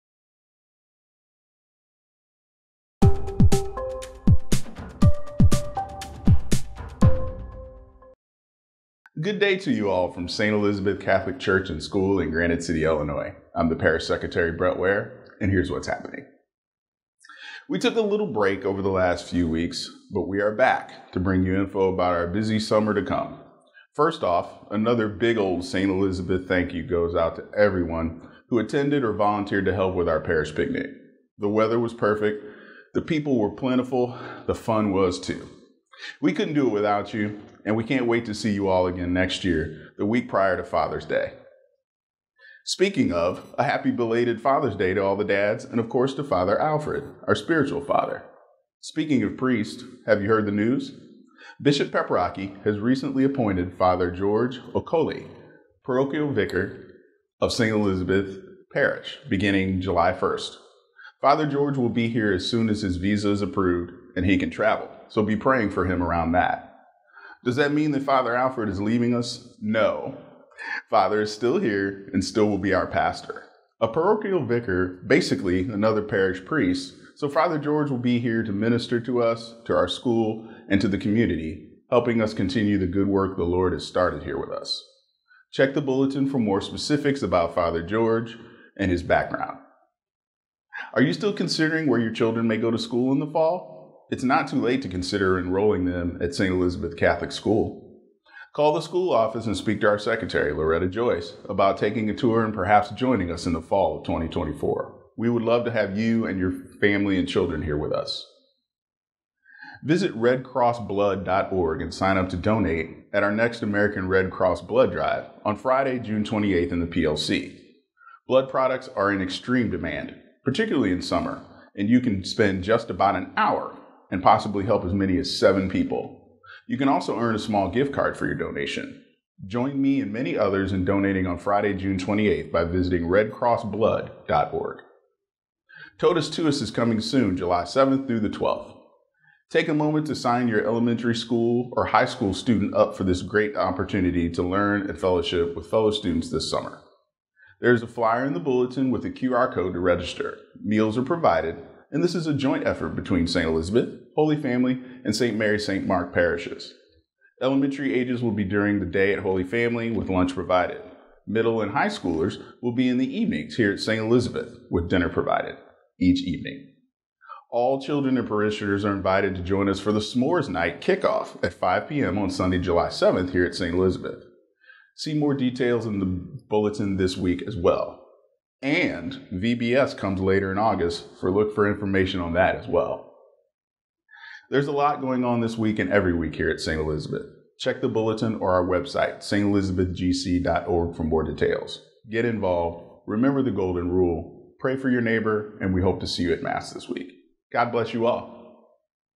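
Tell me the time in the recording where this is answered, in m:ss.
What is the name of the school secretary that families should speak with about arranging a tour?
1:40.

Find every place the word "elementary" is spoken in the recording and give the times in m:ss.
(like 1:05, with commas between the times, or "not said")
2:20, 2:37.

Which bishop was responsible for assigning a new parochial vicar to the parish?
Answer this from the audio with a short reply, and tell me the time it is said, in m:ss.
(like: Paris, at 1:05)
Bishop Paprocki, at 0:51.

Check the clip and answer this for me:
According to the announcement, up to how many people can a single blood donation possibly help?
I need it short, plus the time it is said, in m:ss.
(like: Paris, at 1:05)
7, at 2:05.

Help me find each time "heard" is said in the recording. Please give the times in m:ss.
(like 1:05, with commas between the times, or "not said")
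0:50.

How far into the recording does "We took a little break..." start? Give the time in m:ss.
0:17.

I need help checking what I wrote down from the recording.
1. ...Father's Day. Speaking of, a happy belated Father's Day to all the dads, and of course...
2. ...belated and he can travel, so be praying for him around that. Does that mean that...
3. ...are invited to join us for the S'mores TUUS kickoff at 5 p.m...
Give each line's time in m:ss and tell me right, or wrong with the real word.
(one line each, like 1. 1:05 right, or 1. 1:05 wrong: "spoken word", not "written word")
1. 0:40 right
2. 1:03 wrong: "approved", not "belated"
3. 2:48 wrong: "Night", not "TUUS".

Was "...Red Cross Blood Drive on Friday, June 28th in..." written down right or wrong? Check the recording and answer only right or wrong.
right.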